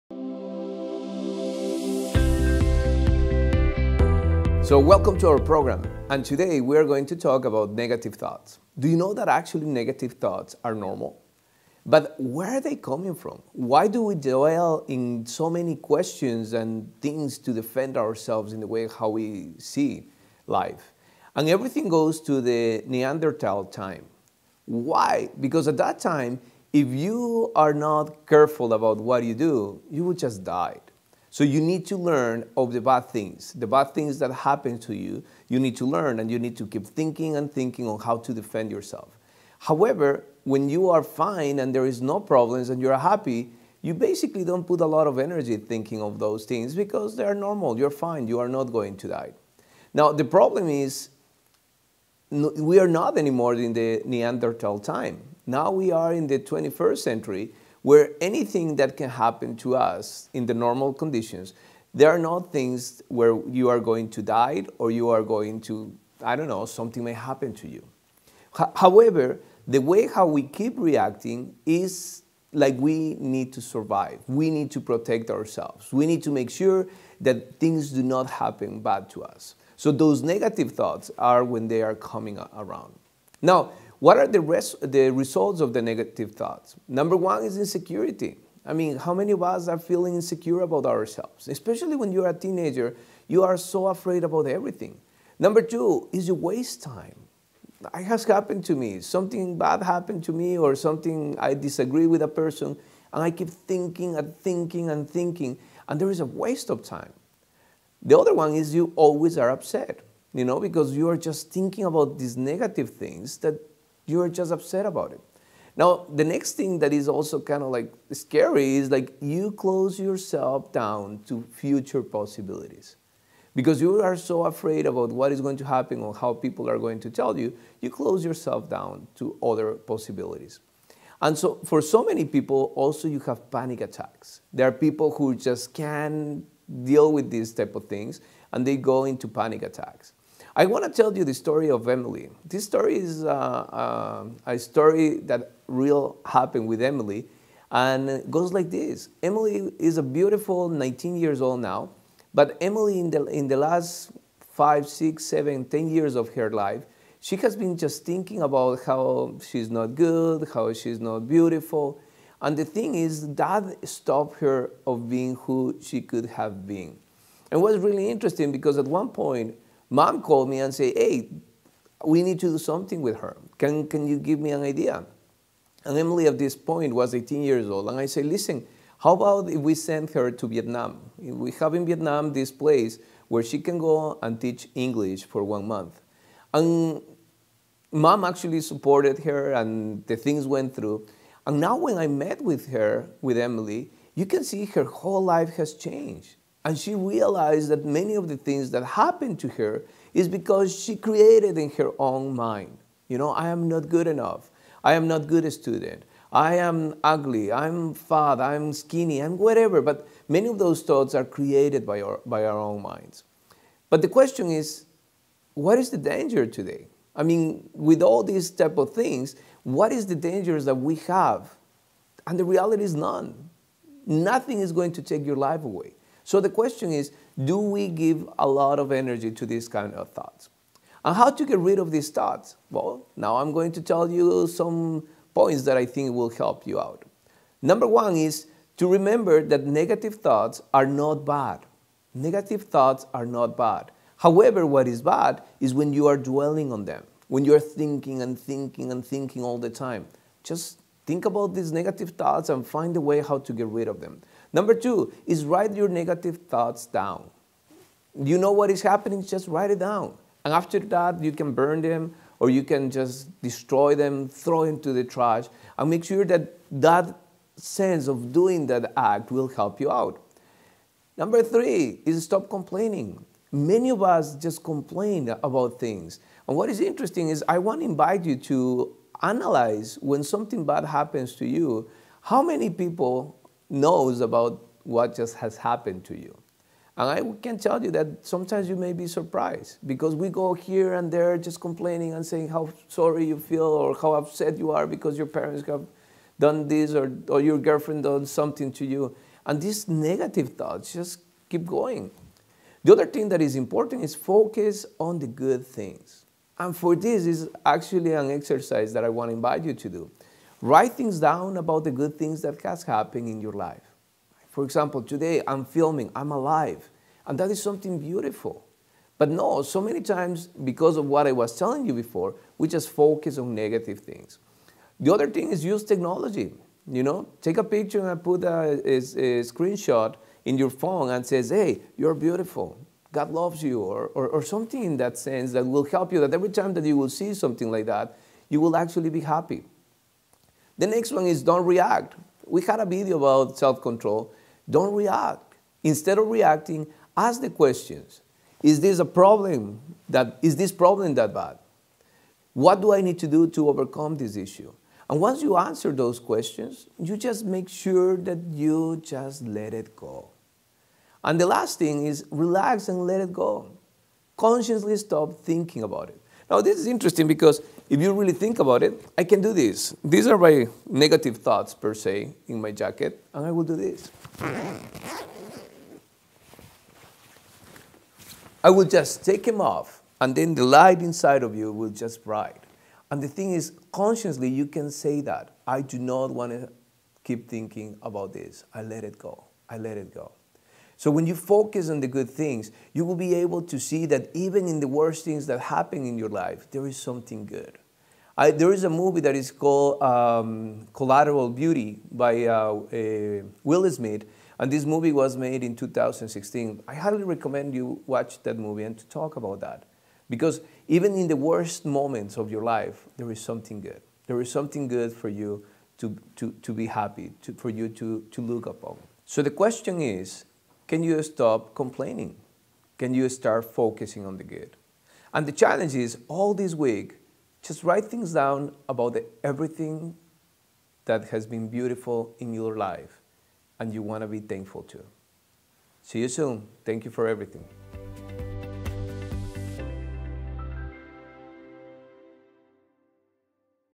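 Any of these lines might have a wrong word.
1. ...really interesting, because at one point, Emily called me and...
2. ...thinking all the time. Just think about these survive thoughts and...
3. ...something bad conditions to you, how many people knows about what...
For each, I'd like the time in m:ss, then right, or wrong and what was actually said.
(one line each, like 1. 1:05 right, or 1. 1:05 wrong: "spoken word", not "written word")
1. 2:47 wrong: "Mom", not "Emily"
2. 4:09 wrong: "negative", not "survive"
3. 4:40 wrong: "happens", not "conditions".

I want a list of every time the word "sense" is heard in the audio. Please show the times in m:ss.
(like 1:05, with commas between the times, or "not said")
4:27, 5:35.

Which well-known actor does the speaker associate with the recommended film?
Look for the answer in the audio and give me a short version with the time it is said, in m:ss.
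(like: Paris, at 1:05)
Will Smith, at 6:43.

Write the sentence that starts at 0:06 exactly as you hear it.
And today we are going to talk about negative thoughts.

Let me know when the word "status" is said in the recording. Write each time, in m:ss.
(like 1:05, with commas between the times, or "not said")
not said.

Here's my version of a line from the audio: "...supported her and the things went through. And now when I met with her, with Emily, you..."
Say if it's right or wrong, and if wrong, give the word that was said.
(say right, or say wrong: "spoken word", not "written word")
right.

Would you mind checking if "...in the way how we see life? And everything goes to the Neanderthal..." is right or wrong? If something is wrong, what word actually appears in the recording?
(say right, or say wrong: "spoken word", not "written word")
right.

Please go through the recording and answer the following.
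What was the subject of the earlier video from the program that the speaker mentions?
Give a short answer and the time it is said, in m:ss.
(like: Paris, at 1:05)
Self control, at 5:43.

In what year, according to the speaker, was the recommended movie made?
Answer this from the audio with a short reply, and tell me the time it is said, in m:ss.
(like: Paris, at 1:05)
2016, at 6:45.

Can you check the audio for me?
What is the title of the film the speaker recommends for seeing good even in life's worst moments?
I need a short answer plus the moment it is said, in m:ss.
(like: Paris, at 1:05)
Collateral Beauty, at 6:40.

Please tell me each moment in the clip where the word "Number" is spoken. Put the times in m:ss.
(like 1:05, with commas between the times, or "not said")
1:26, 1:35, 3:57, 4:14, 4:31.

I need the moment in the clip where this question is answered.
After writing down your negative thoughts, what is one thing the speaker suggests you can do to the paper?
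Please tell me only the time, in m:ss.
4:21.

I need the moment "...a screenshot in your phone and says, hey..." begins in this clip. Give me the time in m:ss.
5:28.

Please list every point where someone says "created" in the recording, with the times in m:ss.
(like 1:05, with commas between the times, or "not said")
3:20, 3:31.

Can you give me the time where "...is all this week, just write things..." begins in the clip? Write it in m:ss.
7:05.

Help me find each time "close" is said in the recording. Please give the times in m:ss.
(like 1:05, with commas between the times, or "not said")
1:59, 2:07.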